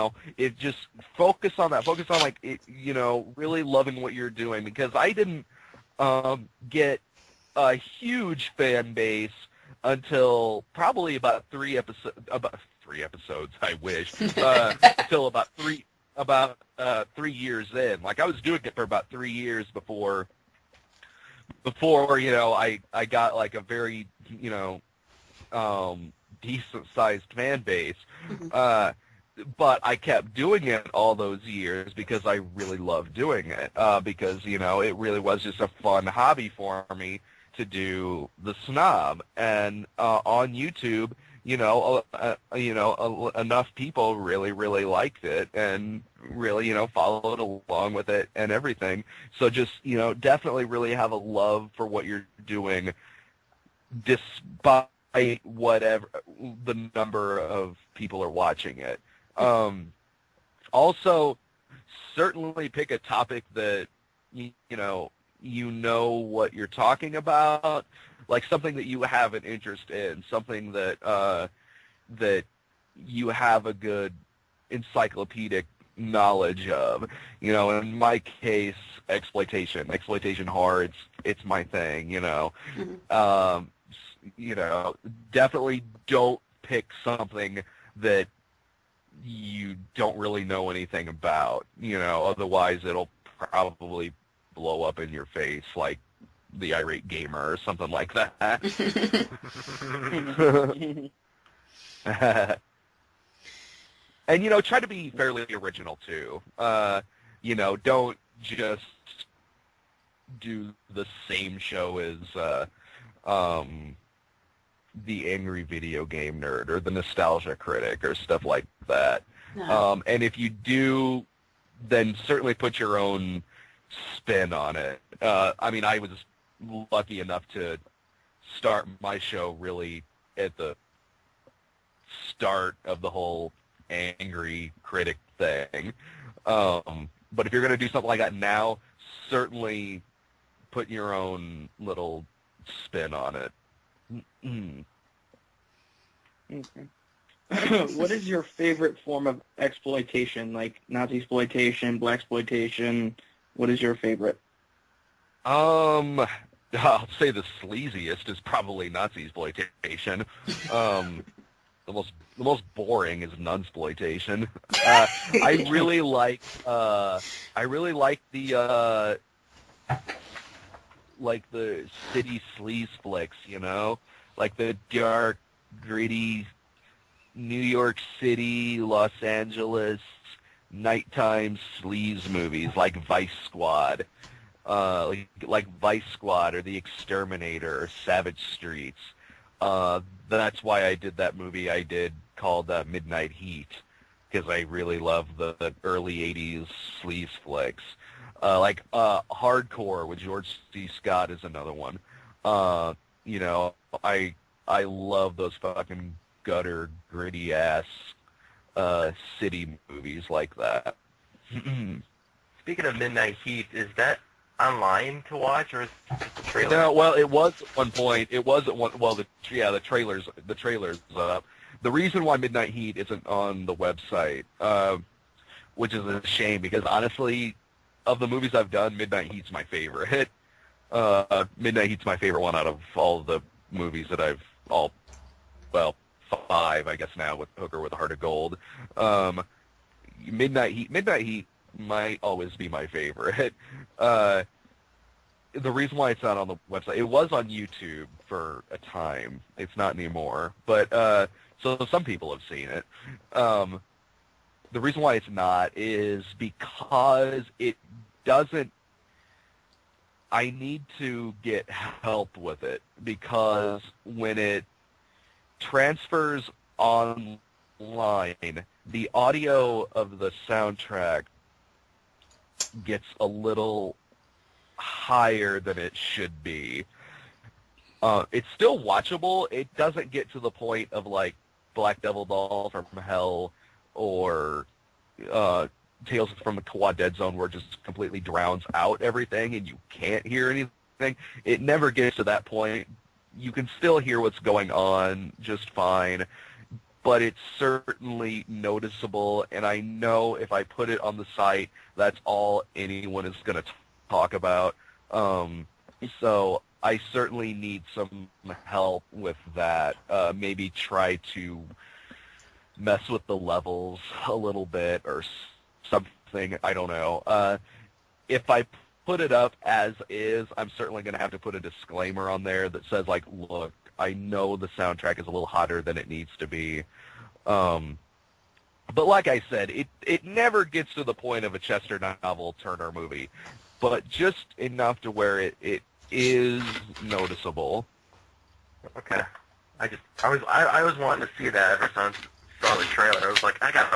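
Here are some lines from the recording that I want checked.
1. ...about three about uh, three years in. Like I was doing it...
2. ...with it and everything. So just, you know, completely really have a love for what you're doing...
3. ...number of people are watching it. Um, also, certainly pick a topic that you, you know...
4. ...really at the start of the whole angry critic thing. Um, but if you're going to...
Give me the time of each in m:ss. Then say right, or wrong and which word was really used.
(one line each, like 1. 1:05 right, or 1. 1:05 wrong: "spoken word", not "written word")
1. 0:15 right
2. 0:47 wrong: "definitely", not "completely"
3. 0:56 right
4. 2:09 right.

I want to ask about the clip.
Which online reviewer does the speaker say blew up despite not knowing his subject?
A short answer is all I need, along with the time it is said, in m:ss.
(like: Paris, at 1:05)
The Irate Gamer, at 1:36.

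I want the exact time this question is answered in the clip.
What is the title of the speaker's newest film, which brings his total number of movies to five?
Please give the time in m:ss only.
3:57.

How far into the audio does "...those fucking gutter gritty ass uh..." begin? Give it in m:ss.
3:25.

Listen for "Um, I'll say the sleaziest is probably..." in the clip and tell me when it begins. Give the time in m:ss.
2:35.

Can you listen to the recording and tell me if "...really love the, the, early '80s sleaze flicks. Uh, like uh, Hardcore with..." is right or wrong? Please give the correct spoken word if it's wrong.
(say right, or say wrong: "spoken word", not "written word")
right.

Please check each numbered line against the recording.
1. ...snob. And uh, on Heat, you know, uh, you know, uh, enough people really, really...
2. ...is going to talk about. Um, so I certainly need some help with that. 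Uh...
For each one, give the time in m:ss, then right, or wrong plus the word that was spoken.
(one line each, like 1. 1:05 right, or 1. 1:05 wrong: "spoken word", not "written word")
1. 0:38 wrong: "YouTube", not "Heat"
2. 5:03 right.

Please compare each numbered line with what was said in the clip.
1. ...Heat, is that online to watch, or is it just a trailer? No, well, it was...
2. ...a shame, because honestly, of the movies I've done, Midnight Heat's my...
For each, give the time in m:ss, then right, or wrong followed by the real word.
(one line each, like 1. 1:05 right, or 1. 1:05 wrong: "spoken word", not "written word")
1. 3:33 right
2. 3:46 right.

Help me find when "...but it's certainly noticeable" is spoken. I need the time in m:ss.
4:57.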